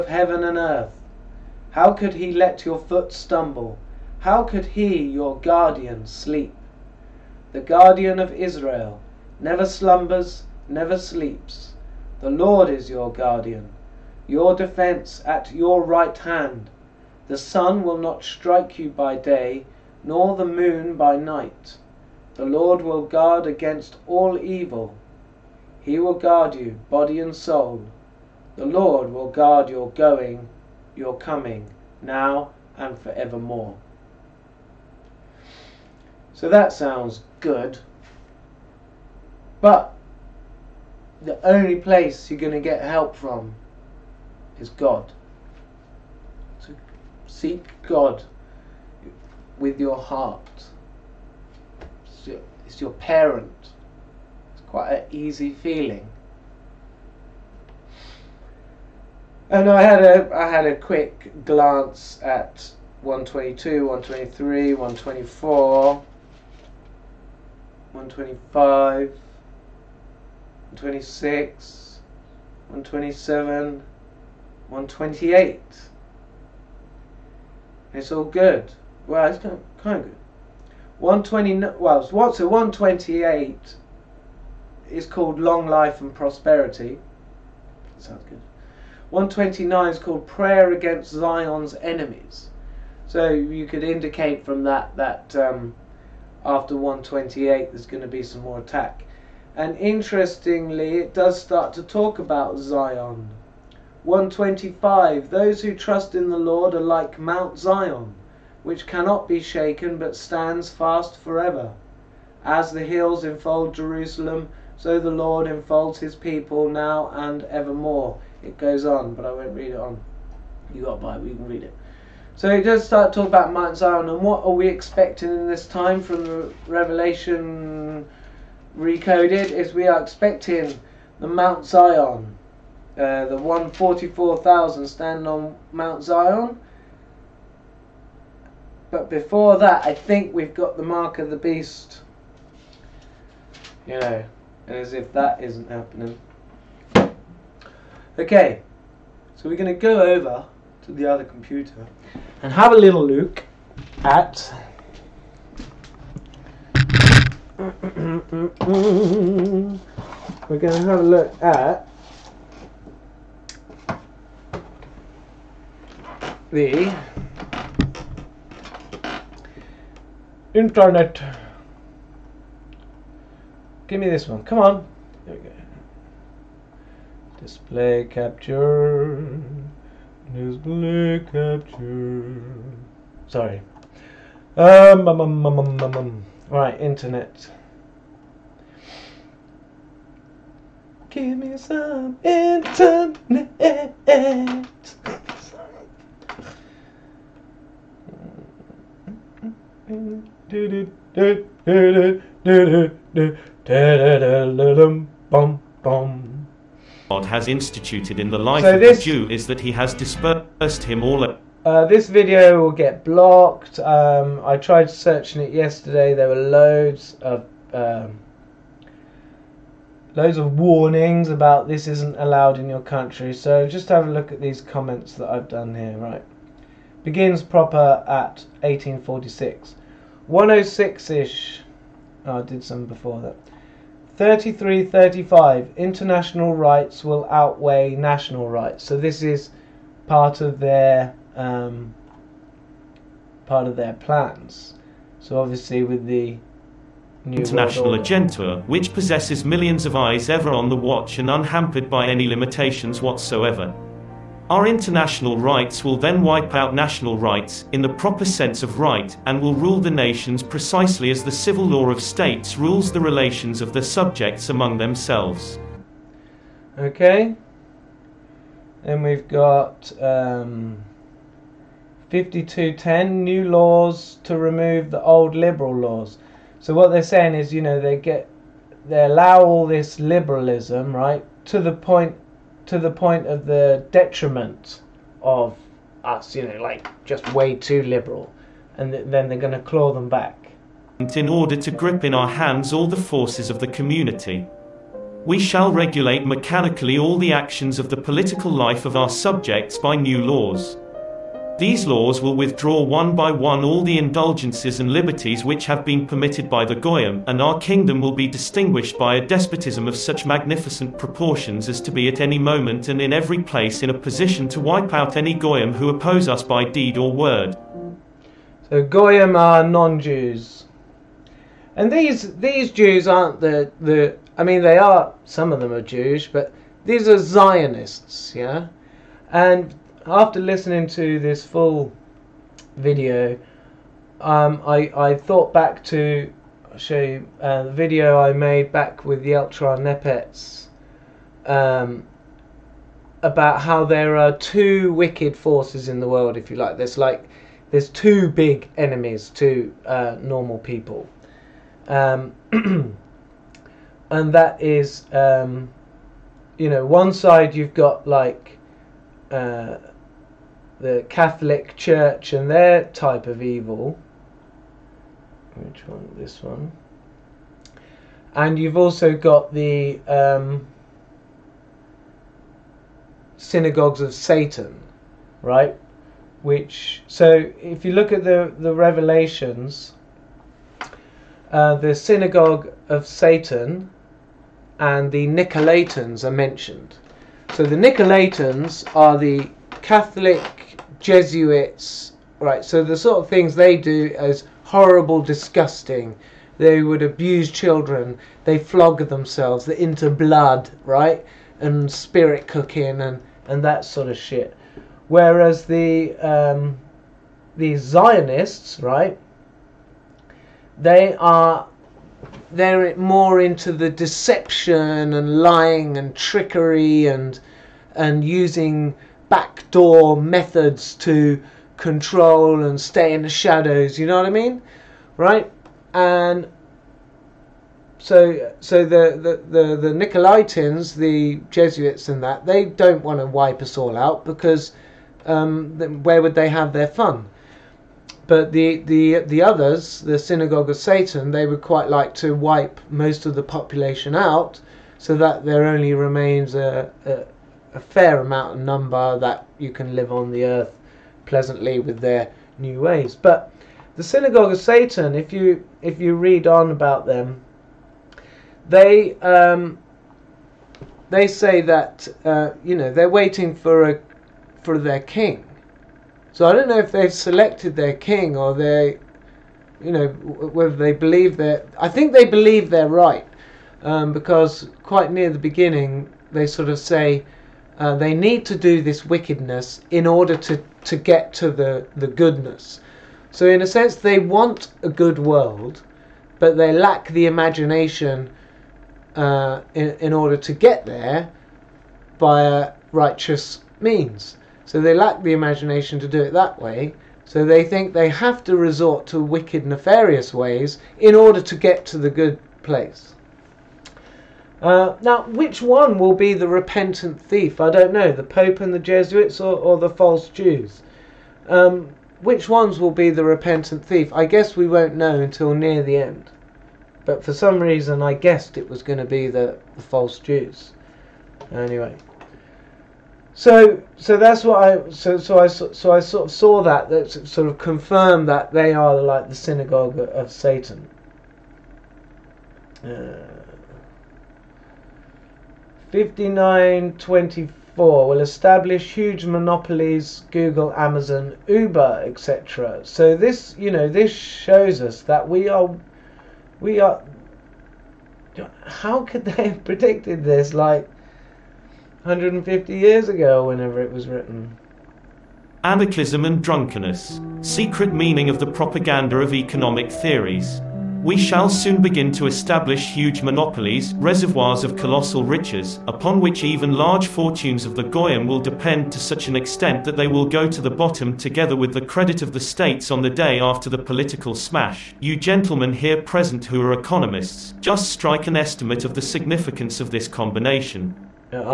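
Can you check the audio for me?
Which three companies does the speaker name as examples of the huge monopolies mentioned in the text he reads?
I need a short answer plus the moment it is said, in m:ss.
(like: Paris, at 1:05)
Google, Amazon, Uber, at 9:00.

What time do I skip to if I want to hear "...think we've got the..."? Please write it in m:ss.
2:19.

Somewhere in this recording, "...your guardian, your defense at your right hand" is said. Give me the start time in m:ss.
0:12.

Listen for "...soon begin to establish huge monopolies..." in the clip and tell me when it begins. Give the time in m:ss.
9:21.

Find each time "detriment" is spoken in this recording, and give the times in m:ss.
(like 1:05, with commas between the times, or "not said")
4:43.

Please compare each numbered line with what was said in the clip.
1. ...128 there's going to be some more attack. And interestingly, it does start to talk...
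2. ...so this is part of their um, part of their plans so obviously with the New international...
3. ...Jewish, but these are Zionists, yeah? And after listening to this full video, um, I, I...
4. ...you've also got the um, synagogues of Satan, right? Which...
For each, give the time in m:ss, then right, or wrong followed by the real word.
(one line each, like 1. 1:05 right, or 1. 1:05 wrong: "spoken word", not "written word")
1. 1:36 right
2. 3:58 right
3. 5:25 right
4. 6:08 right.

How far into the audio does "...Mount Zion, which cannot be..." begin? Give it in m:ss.
1:47.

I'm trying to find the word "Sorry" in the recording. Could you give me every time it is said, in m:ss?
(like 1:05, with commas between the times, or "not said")
3:03, 3:15.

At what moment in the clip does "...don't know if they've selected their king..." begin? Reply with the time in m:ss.
7:46.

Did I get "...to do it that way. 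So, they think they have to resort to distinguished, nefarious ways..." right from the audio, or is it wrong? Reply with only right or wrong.
wrong.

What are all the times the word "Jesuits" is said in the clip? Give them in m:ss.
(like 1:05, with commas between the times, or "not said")
6:31, 7:11, 8:28.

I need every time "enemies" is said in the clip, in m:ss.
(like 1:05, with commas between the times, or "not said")
1:31, 5:48.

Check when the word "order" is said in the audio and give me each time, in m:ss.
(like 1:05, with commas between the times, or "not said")
4:51, 8:00, 8:10, 8:21.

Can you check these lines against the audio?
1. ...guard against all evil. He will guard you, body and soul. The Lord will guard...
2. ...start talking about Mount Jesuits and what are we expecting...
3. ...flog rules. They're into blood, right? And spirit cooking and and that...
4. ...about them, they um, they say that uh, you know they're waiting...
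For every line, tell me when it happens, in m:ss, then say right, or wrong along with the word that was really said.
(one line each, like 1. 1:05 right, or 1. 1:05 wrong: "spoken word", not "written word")
1. 0:23 right
2. 2:02 wrong: "Zion", not "Jesuits"
3. 6:38 wrong: "themselves", not "rules"
4. 7:36 right.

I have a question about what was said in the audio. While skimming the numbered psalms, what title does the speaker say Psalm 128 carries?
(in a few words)
Long Life and Prosperity.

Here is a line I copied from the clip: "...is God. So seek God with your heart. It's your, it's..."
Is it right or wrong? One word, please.
right.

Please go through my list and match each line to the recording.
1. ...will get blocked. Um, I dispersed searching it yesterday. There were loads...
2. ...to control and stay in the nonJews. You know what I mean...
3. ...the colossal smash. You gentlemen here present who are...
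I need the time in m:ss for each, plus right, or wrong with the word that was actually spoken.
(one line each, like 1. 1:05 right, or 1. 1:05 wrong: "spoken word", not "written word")
1. 3:32 wrong: "tried", not "dispersed"
2. 7:00 wrong: "shadows", not "nonJews"
3. 9:33 wrong: "political", not "colossal".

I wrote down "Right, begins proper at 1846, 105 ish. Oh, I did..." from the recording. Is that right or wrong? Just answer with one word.
wrong.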